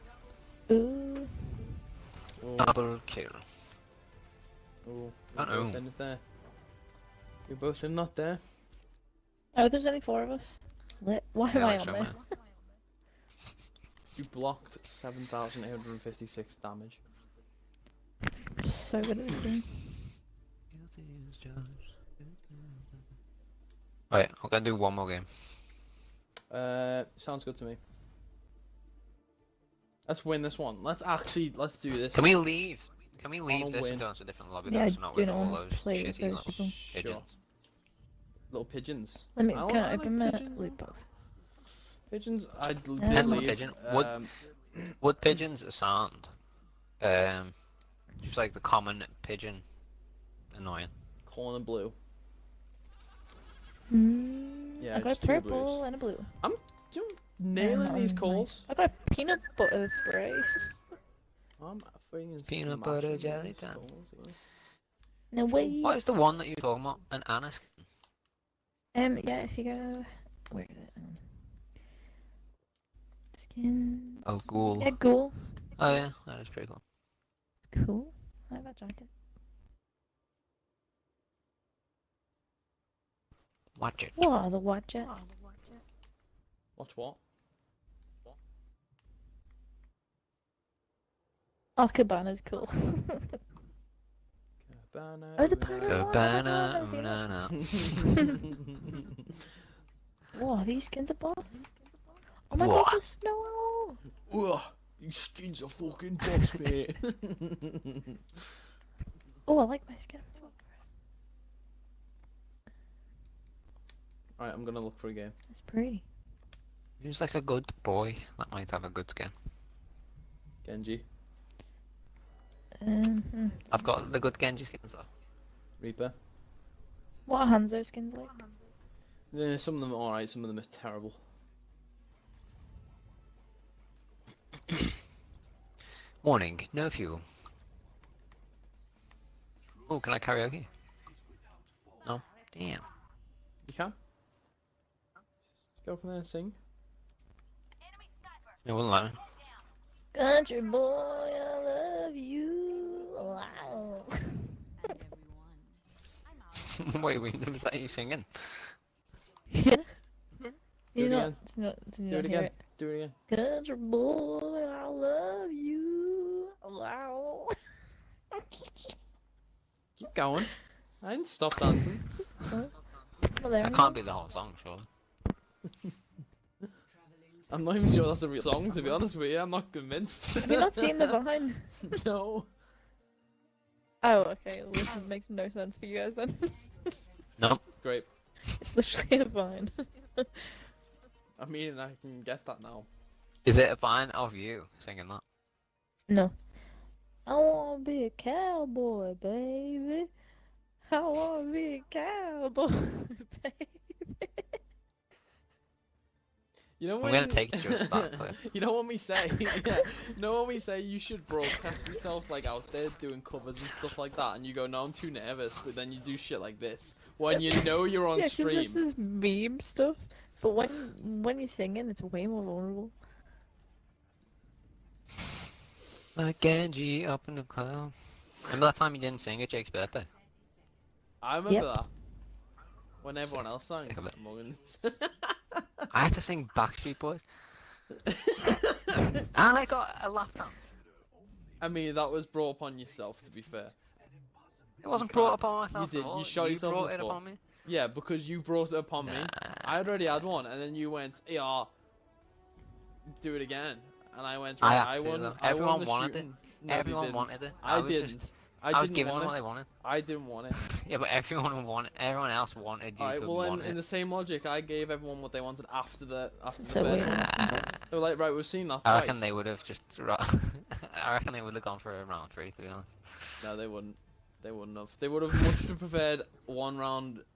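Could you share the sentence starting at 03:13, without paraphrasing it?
Is it a vine of you singing that?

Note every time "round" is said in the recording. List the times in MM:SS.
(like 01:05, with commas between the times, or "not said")
04:32, 04:36.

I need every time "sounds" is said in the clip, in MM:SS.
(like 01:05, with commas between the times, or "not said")
00:27, 00:45.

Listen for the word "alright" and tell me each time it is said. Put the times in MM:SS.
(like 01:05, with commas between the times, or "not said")
00:24, 01:54, 02:09.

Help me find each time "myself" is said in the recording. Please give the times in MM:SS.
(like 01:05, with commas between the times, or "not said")
04:05.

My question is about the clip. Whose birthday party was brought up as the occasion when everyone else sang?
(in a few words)
Jake's.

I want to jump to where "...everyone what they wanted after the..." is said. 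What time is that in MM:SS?
04:24.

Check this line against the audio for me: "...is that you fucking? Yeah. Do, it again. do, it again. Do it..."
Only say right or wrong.
wrong.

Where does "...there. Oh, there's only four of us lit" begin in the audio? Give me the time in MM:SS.
00:08.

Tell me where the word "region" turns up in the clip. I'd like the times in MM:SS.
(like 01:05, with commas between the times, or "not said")
not said.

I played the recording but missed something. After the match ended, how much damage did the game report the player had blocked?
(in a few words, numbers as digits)
7,856.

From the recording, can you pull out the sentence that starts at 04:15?
To, Everyone I won wanted shooting.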